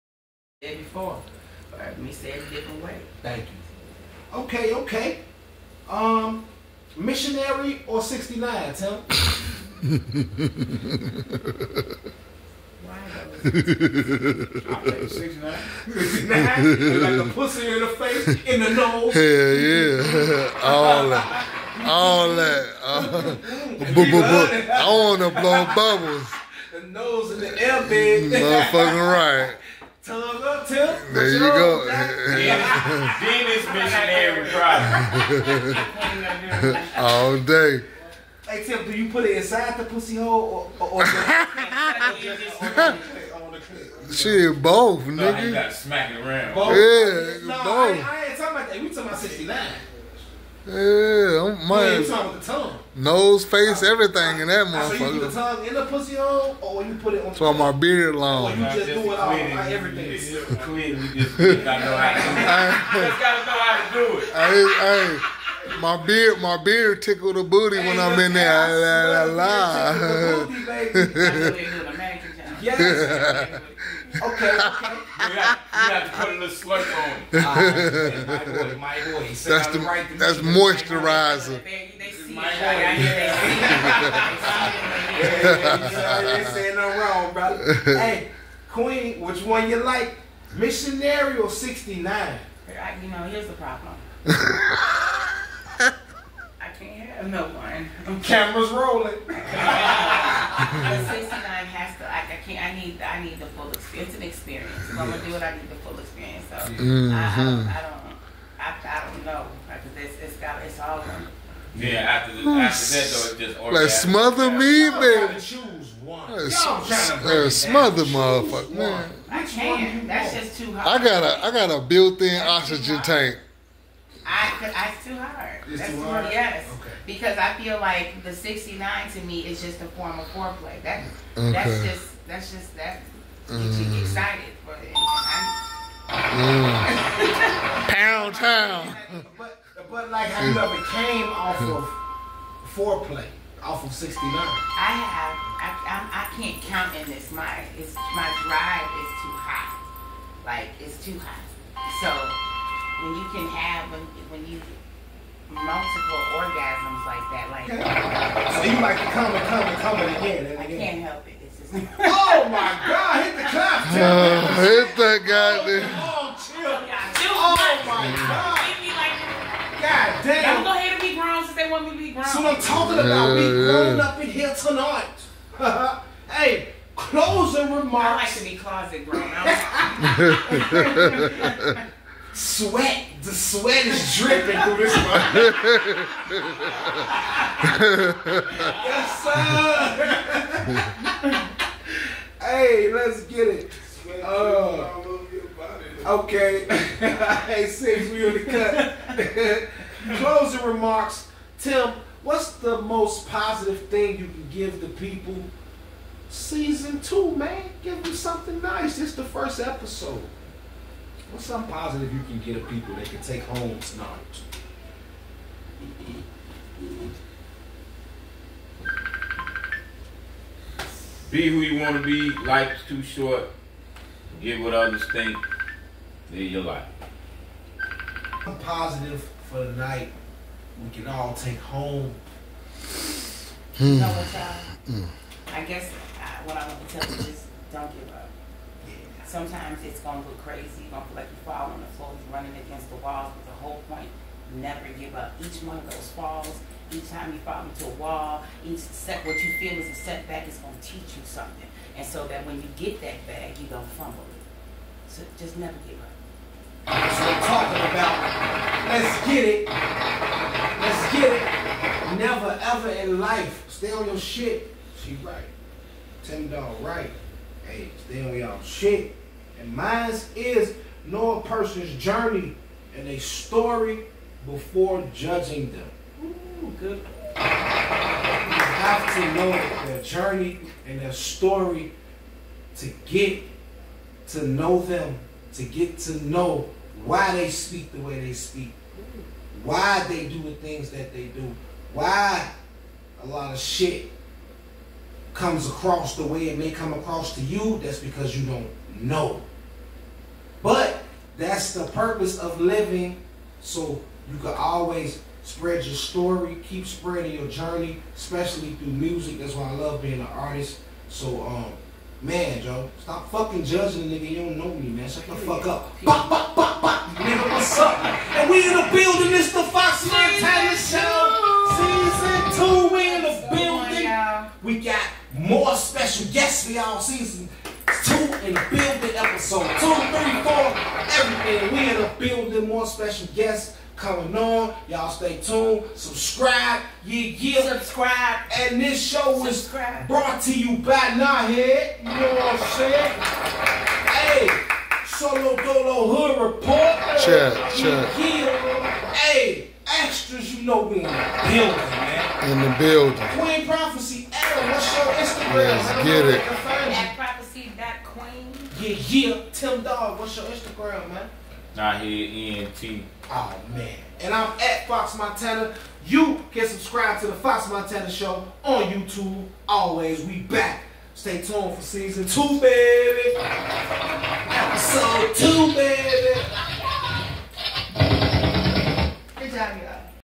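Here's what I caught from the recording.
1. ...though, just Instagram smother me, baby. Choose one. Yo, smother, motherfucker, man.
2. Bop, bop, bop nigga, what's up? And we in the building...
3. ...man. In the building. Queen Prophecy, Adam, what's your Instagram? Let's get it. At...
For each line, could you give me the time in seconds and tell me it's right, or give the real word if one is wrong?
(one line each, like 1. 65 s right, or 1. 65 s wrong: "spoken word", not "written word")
1. 113 s wrong: "Like", not "Instagram"
2. 316 s right
3. 351 s right.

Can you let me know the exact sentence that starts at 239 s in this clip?
Sometimes it's going to look crazy.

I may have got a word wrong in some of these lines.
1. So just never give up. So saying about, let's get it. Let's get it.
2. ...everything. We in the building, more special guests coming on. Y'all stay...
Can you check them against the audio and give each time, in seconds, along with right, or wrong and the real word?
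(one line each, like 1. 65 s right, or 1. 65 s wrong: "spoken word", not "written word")
1. 255 s wrong: "talking", not "saying"
2. 331 s right.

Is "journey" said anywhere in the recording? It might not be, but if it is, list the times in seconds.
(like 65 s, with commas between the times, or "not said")
272 s, 280 s, 307 s.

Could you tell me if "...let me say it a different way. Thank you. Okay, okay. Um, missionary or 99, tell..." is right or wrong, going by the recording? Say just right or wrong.
wrong.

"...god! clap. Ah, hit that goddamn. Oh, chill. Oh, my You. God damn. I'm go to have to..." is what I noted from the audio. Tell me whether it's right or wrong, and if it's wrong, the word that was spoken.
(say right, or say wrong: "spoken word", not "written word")
wrong: "God", not "You".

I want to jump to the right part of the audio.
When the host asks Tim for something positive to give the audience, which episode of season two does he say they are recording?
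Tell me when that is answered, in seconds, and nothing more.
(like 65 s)
209 s.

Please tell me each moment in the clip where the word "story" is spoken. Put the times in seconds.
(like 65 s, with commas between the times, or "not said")
273 s, 281 s, 305 s.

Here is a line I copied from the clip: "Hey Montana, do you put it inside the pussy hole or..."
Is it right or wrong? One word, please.
wrong.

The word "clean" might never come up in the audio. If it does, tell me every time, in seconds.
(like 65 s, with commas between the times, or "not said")
60 s.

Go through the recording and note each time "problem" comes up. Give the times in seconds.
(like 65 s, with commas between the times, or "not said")
34 s, 93 s.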